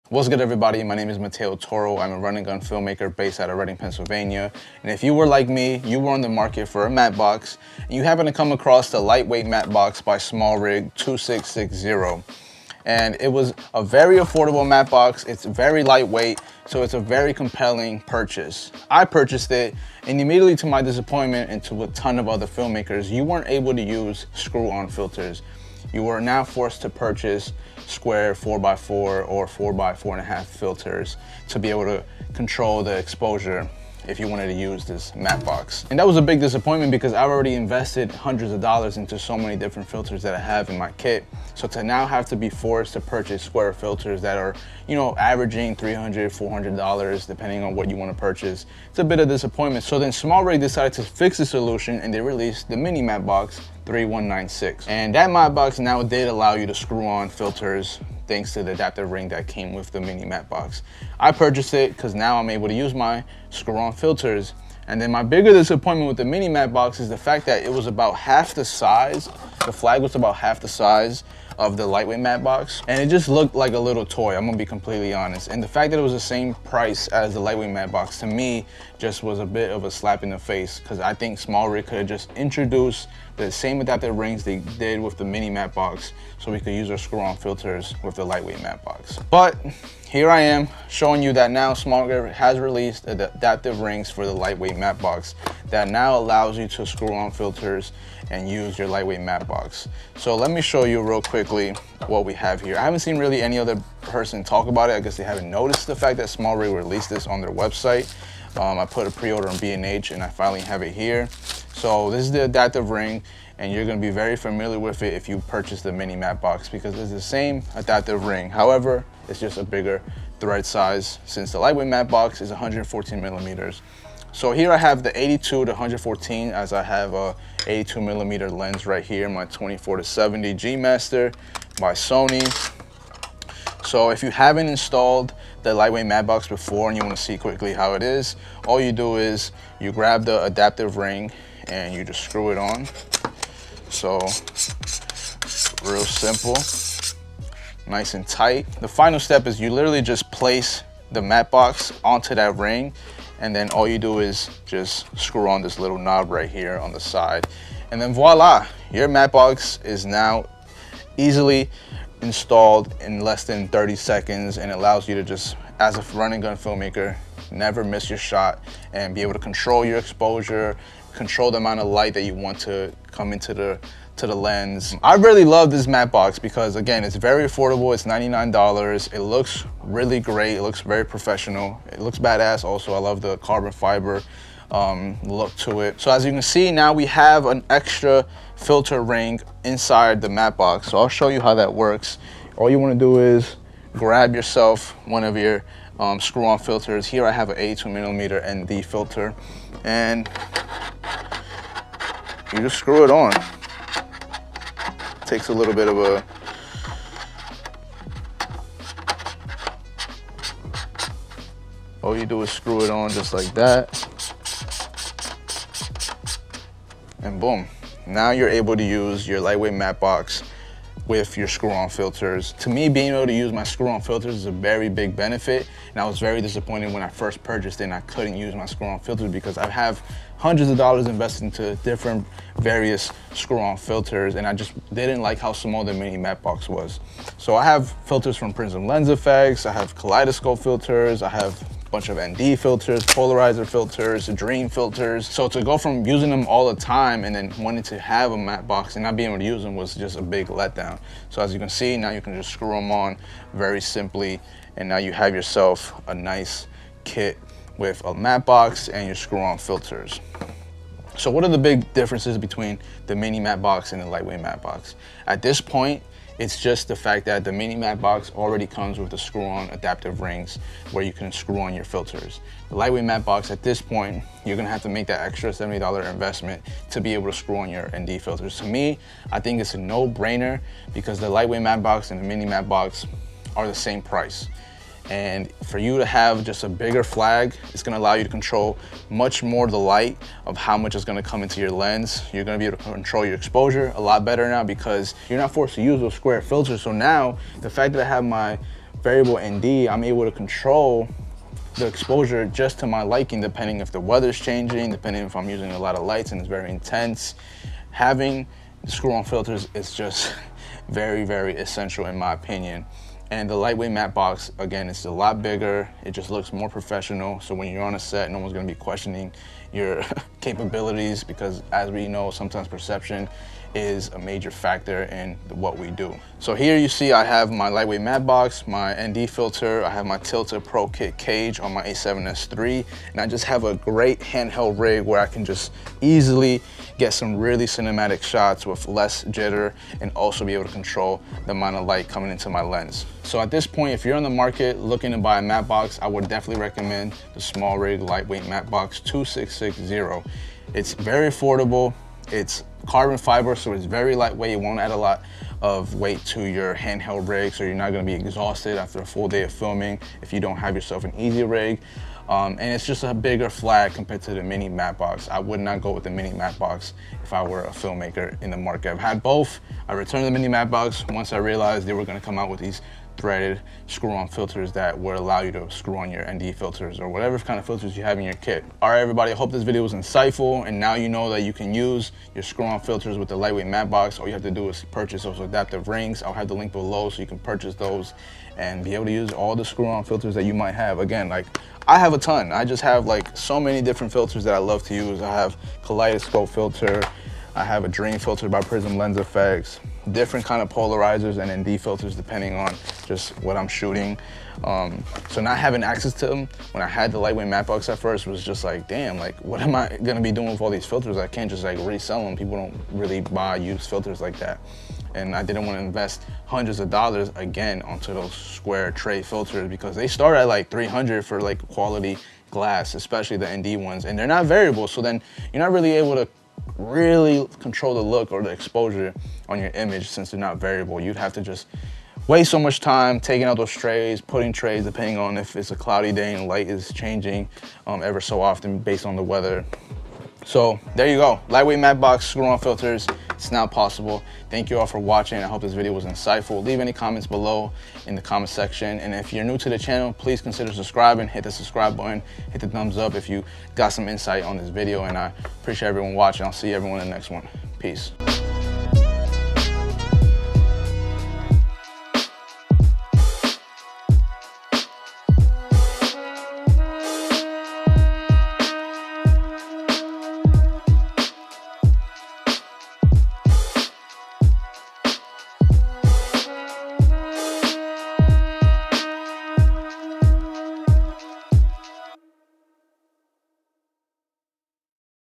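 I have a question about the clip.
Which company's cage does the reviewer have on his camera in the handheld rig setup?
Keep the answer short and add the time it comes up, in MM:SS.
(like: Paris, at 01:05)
Tilta, at 05:30.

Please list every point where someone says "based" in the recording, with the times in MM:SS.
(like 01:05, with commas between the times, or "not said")
00:03, 07:18.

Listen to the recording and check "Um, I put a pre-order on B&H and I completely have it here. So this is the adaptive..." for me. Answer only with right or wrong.
wrong.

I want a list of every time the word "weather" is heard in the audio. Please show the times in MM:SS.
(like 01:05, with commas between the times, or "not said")
05:03, 07:19.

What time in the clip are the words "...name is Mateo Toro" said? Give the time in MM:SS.
00:00.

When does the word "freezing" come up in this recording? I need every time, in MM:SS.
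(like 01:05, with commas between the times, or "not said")
not said.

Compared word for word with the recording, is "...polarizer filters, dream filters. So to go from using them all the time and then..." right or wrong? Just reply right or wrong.
right.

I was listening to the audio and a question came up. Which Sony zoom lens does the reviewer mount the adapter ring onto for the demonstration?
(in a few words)
24-70 G Master.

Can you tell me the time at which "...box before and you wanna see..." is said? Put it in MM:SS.
02:16.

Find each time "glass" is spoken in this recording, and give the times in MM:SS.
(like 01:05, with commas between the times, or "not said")
07:02.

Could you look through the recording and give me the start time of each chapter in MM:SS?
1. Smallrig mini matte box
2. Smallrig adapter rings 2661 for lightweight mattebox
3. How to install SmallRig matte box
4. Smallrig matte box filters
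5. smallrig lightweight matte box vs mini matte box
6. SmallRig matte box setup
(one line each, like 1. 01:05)
1. 00:49
2. 01:29
3. 02:10
4. 03:05
5. 04:20
6. 05:25.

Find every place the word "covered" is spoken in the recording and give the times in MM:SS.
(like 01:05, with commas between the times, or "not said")
not said.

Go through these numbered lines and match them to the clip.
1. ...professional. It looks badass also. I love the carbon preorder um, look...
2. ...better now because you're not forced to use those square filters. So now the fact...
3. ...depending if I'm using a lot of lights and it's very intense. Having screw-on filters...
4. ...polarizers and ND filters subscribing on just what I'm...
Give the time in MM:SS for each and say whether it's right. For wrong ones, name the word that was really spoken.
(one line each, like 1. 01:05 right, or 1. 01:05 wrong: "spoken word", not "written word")
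1. 03:01 wrong: "fiber", not "preorder"
2. 04:54 right
3. 05:04 right
4. 06:40 wrong: "depending", not "subscribing".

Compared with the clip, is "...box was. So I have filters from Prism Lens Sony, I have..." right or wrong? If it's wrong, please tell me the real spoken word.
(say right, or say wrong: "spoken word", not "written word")
wrong: "Effects", not "Sony".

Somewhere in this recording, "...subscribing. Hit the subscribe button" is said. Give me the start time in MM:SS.
07:30.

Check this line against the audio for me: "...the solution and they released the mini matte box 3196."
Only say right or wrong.
right.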